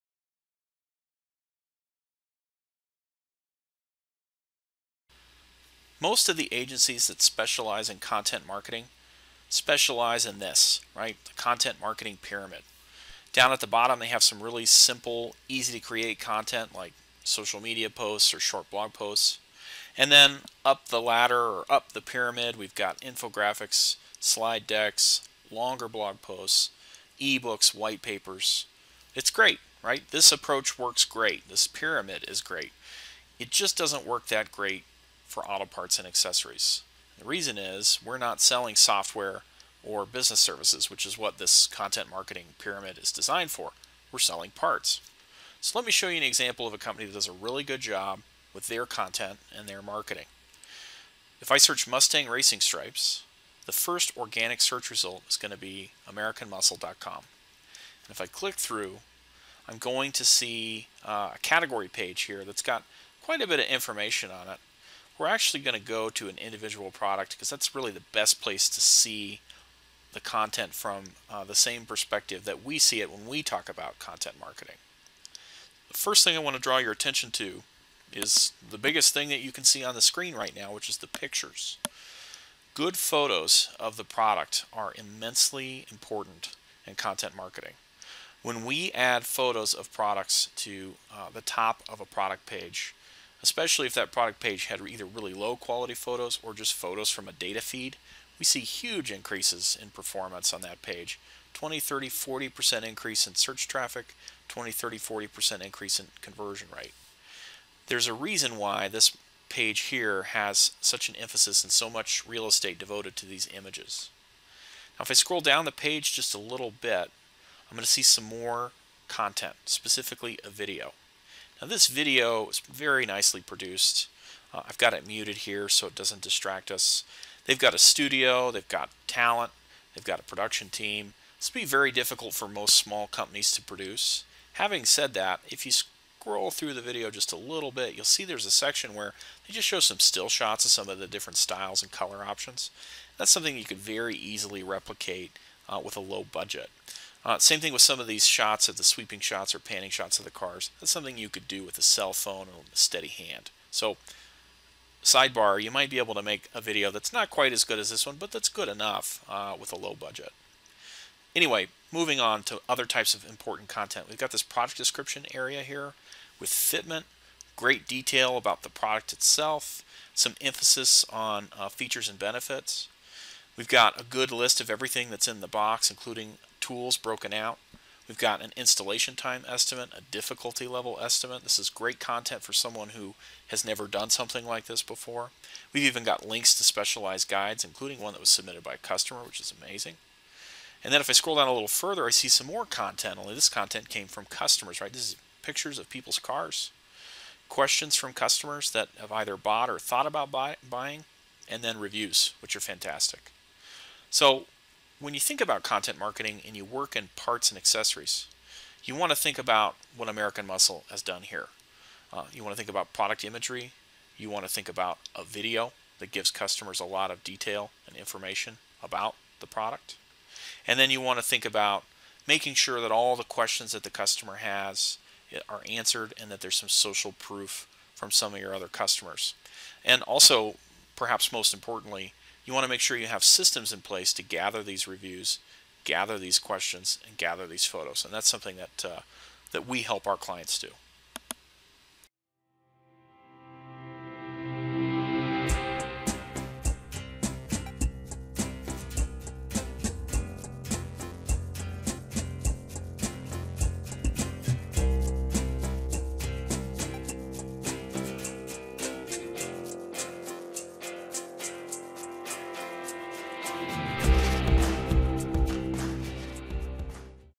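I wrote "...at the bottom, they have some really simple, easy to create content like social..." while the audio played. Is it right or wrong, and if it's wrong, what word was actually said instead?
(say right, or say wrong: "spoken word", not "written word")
right.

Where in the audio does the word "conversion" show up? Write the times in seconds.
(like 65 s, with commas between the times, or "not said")
106 s.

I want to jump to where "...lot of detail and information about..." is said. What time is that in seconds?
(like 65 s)
216 s.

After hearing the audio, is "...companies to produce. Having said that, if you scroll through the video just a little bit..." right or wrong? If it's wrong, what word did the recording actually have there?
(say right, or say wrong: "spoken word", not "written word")
right.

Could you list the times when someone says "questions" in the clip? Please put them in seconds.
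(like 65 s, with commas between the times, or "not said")
197 s, 223 s, 236 s.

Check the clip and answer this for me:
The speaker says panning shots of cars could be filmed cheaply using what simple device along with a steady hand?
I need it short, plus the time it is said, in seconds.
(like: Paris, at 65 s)
A cell phone, at 151 s.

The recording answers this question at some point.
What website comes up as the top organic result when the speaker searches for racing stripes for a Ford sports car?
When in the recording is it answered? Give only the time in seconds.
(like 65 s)
56 s.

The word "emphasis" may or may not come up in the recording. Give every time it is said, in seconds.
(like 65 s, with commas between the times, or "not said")
111 s, 170 s.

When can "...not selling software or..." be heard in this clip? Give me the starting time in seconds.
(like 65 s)
38 s.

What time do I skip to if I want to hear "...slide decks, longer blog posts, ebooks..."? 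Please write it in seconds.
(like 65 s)
24 s.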